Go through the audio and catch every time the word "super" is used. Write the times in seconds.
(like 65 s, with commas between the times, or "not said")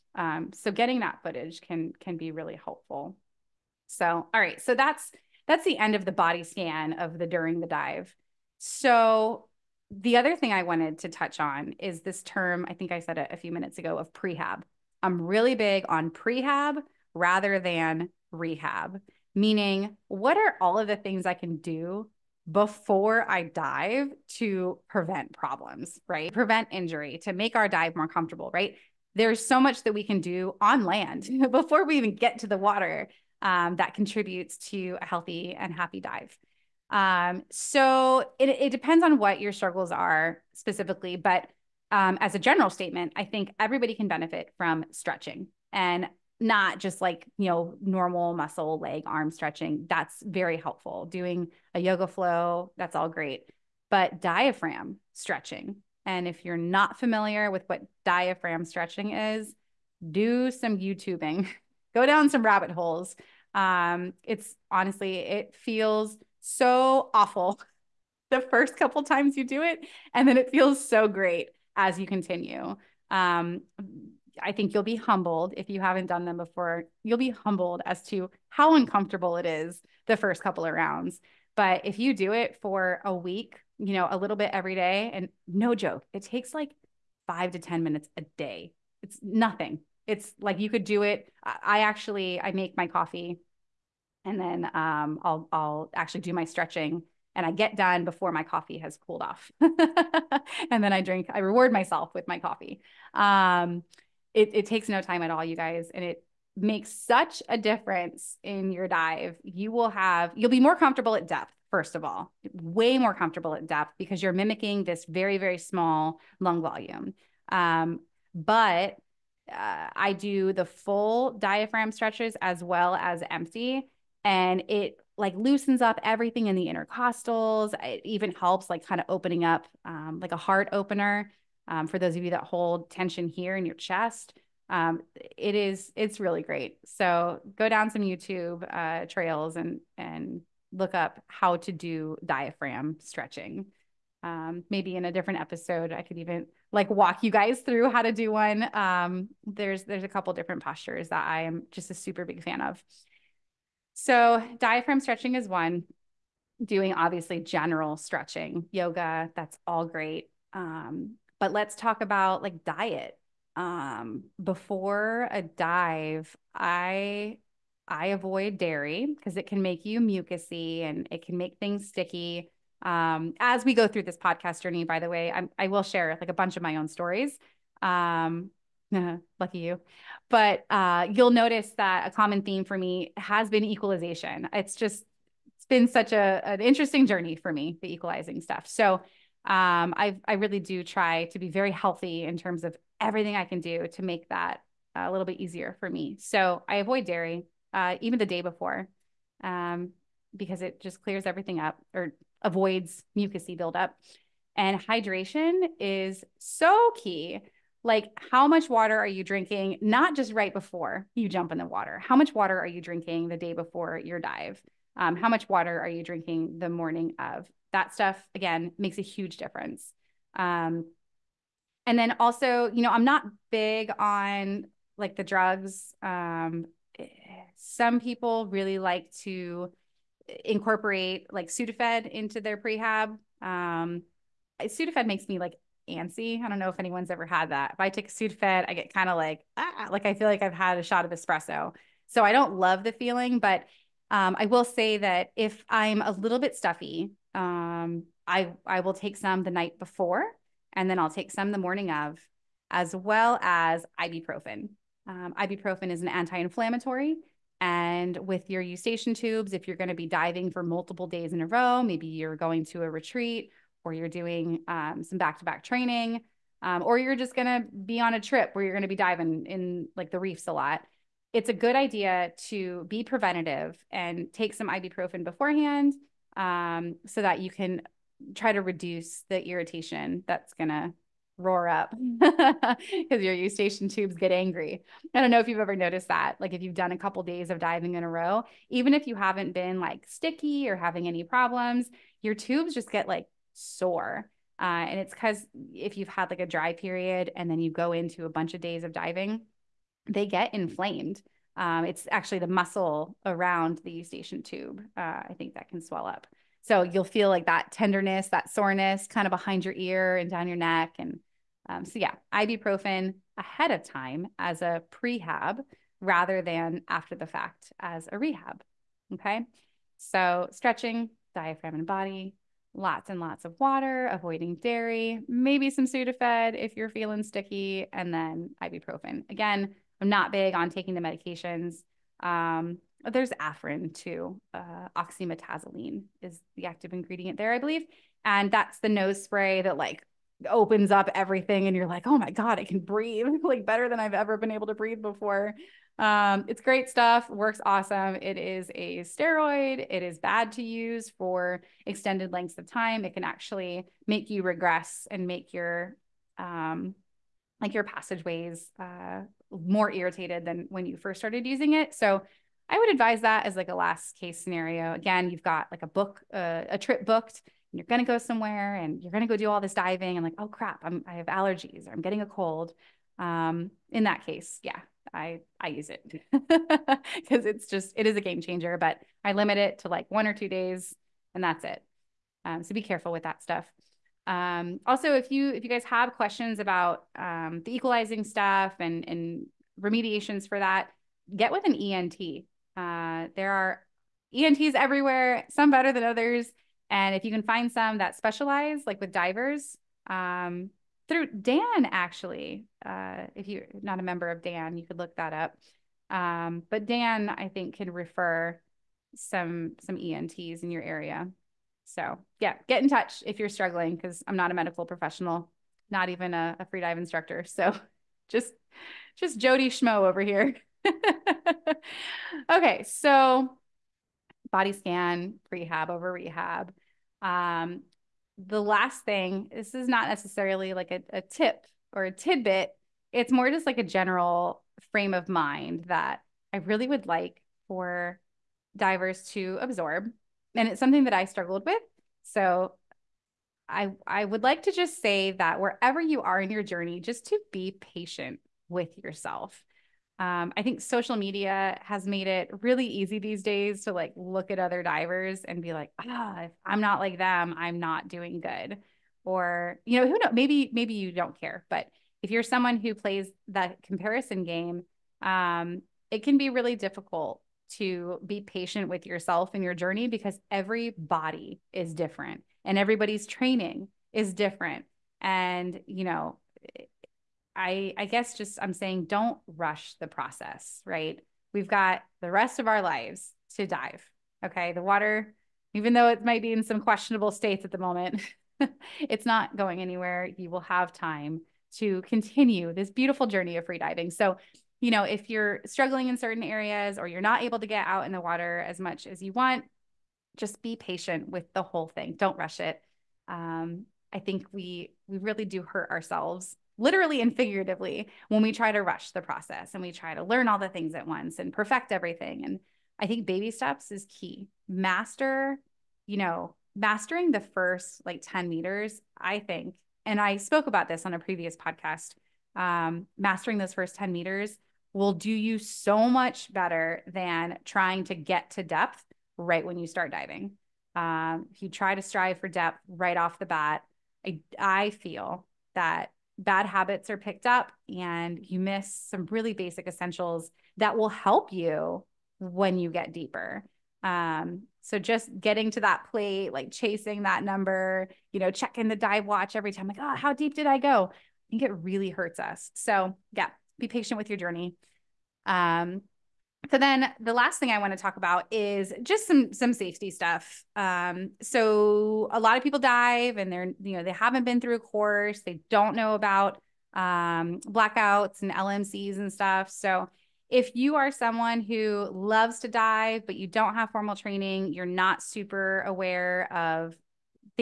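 151 s, 575 s.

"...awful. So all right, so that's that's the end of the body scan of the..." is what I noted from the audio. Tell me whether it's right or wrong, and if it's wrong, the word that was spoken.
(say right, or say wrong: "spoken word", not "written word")
wrong: "helpful", not "awful".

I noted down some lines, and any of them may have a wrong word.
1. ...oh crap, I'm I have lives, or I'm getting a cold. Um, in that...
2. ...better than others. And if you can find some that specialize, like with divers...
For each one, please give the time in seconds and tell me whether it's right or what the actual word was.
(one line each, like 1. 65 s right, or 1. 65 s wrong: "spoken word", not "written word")
1. 370 s wrong: "allergies", not "lives"
2. 395 s right.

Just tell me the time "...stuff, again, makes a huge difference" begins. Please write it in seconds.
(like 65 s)
217 s.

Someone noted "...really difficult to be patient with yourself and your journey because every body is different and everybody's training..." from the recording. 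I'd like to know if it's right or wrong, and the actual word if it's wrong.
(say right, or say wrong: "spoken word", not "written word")
right.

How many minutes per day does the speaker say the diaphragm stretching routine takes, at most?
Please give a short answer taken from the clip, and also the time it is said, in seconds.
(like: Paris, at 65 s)
10, at 87 s.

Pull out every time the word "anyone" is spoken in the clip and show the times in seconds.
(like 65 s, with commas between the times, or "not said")
236 s.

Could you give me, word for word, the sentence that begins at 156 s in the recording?
Doing obviously general stretching, yoga, that's all great.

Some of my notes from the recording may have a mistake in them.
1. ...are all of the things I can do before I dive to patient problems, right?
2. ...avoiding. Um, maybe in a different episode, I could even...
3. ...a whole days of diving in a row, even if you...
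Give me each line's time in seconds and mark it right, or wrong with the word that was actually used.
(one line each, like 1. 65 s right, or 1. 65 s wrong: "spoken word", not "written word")
1. 20 s wrong: "prevent", not "patient"
2. 142 s wrong: "stretching", not "avoiding"
3. 286 s wrong: "couple", not "whole".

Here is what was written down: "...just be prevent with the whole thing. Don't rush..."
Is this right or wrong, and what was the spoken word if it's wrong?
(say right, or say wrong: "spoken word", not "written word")
wrong: "patient", not "prevent".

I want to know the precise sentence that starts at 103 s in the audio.
Um, it, it takes no time at all, you guys.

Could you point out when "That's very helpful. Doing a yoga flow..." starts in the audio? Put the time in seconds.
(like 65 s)
49 s.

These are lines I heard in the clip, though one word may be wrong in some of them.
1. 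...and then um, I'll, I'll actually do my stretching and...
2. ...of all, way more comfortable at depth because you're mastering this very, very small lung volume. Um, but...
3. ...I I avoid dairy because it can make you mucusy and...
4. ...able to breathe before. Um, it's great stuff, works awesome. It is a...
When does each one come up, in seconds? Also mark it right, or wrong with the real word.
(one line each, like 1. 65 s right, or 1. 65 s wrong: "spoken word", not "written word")
1. 94 s right
2. 111 s wrong: "mimicking", not "mastering"
3. 166 s right
4. 344 s right.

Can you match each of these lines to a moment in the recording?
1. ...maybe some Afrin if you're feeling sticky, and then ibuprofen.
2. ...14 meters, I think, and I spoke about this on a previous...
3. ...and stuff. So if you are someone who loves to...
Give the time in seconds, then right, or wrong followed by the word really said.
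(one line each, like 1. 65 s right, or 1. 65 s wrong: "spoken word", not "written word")
1. 325 s wrong: "Sudafed", not "Afrin"
2. 518 s wrong: "10", not "14"
3. 569 s right.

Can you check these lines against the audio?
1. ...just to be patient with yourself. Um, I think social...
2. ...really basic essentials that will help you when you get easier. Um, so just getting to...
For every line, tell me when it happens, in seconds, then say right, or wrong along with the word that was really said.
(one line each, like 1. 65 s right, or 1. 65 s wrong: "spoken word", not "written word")
1. 447 s right
2. 539 s wrong: "deeper", not "easier".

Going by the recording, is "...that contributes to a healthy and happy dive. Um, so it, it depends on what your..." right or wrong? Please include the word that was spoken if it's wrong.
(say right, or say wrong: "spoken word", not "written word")
right.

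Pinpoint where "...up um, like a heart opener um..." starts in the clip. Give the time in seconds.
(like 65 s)
129 s.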